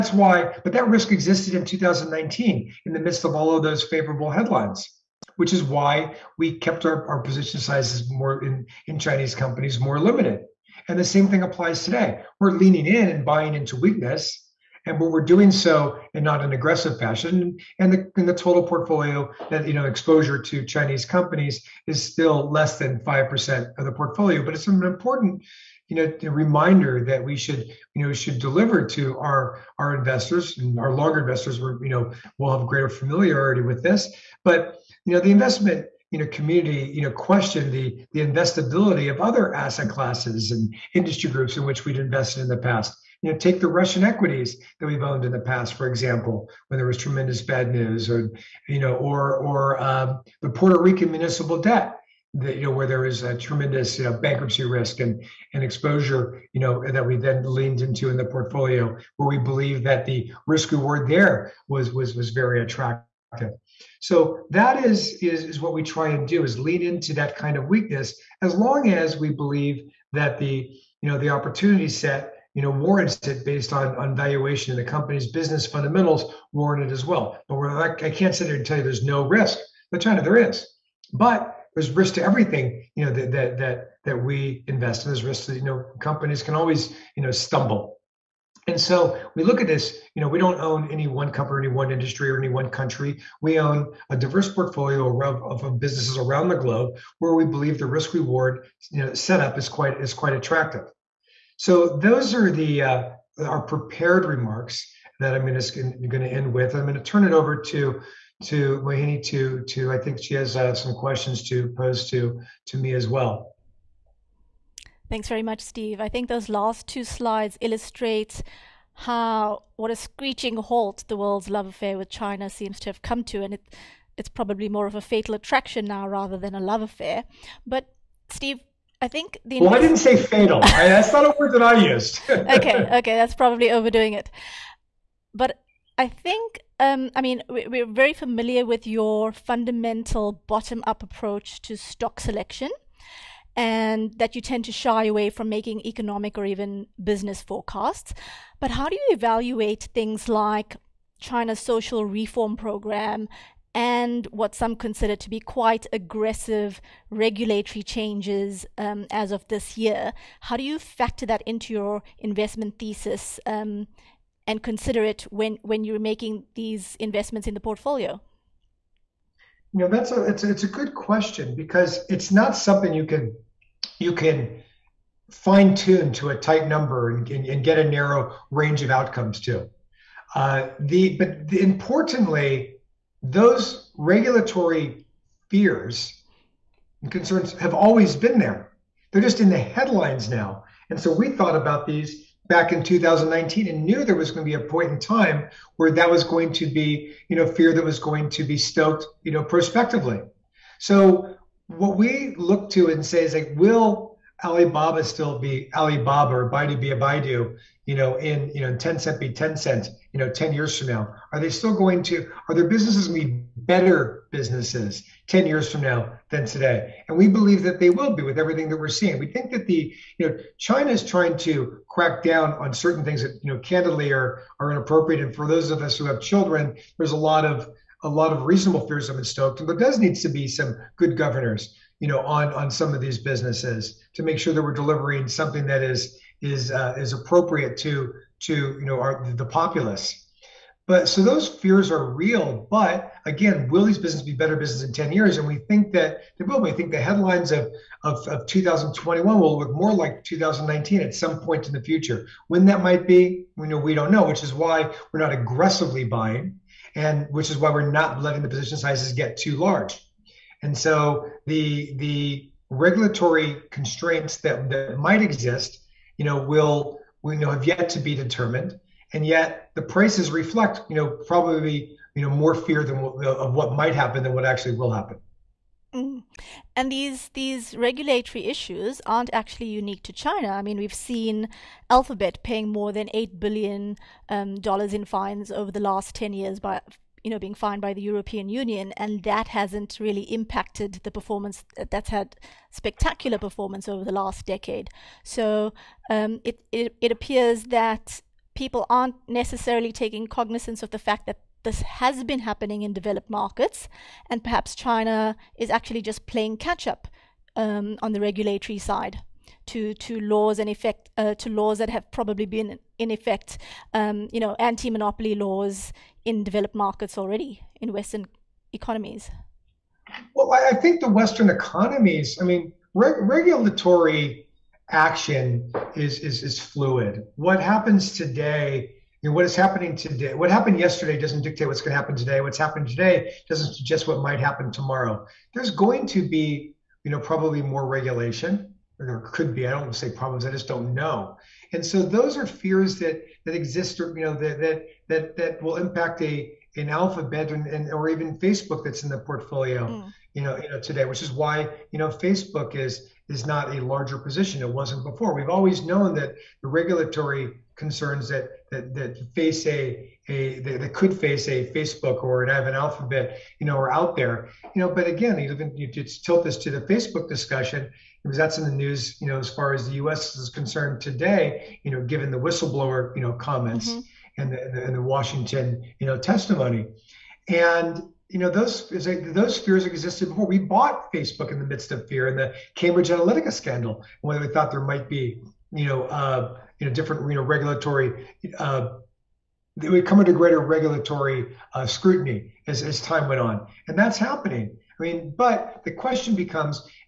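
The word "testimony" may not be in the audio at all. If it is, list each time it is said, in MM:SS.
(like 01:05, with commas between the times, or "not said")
06:16.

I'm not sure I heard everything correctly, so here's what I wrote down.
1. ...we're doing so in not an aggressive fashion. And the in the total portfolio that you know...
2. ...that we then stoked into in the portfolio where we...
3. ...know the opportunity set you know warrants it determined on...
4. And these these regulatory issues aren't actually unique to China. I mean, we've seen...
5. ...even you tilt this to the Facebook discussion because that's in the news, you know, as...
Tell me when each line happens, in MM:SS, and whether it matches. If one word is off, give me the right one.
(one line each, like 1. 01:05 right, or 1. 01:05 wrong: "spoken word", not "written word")
1. 00:15 right
2. 00:56 wrong: "leaned", not "stoked"
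3. 01:11 wrong: "based", not "determined"
4. 04:36 right
5. 06:05 right.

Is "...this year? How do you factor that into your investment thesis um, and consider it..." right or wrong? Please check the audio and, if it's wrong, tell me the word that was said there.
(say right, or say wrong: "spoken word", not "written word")
right.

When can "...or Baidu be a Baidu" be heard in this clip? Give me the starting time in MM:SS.
03:26.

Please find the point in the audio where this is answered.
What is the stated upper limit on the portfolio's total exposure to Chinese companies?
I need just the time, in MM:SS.
00:22.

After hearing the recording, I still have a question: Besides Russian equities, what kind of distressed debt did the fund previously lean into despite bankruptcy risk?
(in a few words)
Puerto Rican municipal debt.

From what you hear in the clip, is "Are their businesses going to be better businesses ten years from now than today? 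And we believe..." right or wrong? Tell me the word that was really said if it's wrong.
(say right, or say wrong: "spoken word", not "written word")
right.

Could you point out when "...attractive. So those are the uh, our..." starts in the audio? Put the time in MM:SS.
01:40.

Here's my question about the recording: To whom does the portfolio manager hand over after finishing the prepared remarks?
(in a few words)
Mohini.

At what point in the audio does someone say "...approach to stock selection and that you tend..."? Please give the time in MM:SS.
02:21.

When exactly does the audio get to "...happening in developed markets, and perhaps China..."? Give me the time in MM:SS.
05:02.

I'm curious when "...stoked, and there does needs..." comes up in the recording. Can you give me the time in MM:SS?
03:49.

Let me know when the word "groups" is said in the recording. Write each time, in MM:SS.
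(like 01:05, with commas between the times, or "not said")
00:41.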